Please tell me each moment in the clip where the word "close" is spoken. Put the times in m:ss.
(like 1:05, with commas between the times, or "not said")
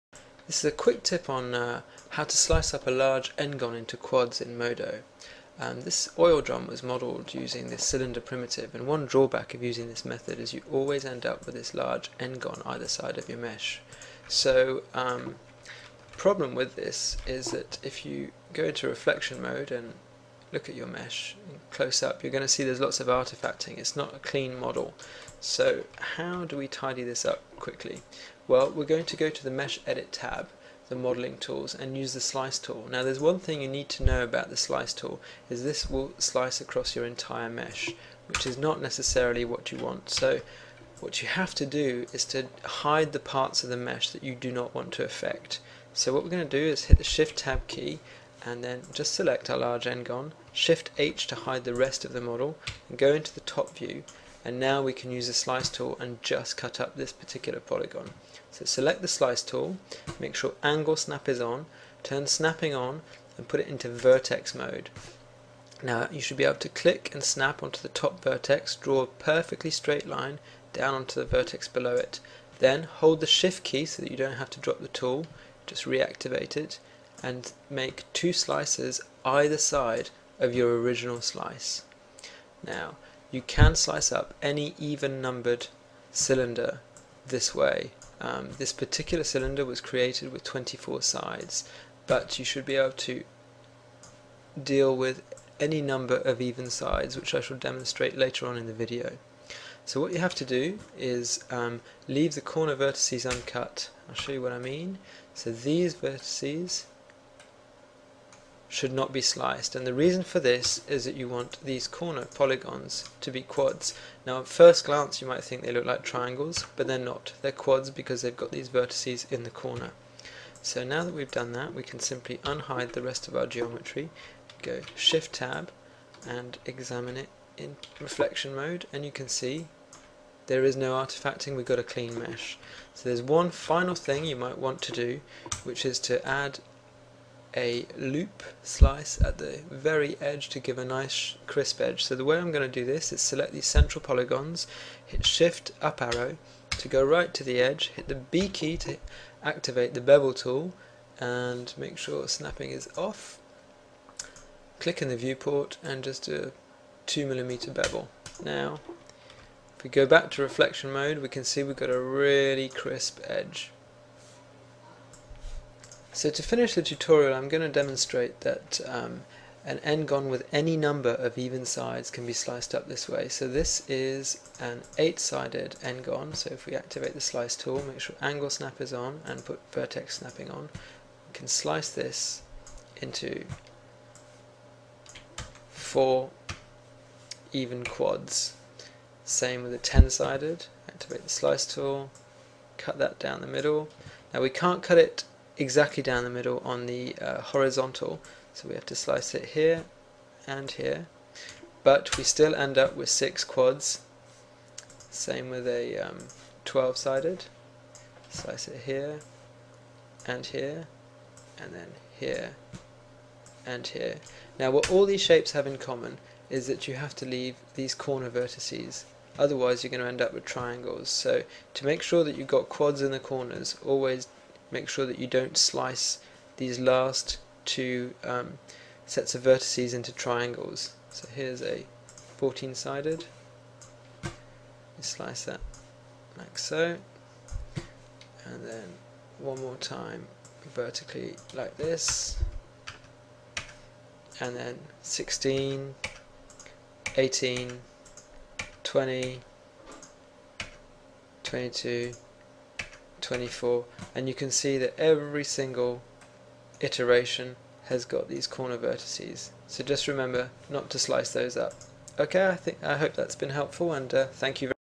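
0:21.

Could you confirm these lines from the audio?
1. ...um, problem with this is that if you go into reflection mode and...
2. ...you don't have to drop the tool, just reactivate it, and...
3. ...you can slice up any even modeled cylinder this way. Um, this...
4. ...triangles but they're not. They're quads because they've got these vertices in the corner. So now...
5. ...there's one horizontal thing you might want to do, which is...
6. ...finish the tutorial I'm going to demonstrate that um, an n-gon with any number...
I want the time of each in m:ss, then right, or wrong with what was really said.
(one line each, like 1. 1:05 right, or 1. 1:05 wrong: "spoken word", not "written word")
1. 0:14 right
2. 1:14 right
3. 1:23 wrong: "numbered", not "modeled"
4. 1:56 right
5. 2:13 wrong: "final", not "horizontal"
6. 2:46 right.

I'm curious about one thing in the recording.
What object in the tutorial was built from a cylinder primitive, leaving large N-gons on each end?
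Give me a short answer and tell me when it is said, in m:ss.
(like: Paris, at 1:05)
Oil drum, at 0:06.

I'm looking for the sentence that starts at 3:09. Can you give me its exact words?
Same with the 10-sided, activate the slice tool, cut that down the middle.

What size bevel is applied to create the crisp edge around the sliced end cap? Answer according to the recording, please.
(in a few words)
2mm.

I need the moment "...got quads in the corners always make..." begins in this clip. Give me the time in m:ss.
3:42.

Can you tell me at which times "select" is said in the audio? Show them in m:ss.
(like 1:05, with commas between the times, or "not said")
0:49, 0:58, 2:23.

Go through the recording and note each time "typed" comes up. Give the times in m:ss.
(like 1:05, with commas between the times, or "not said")
not said.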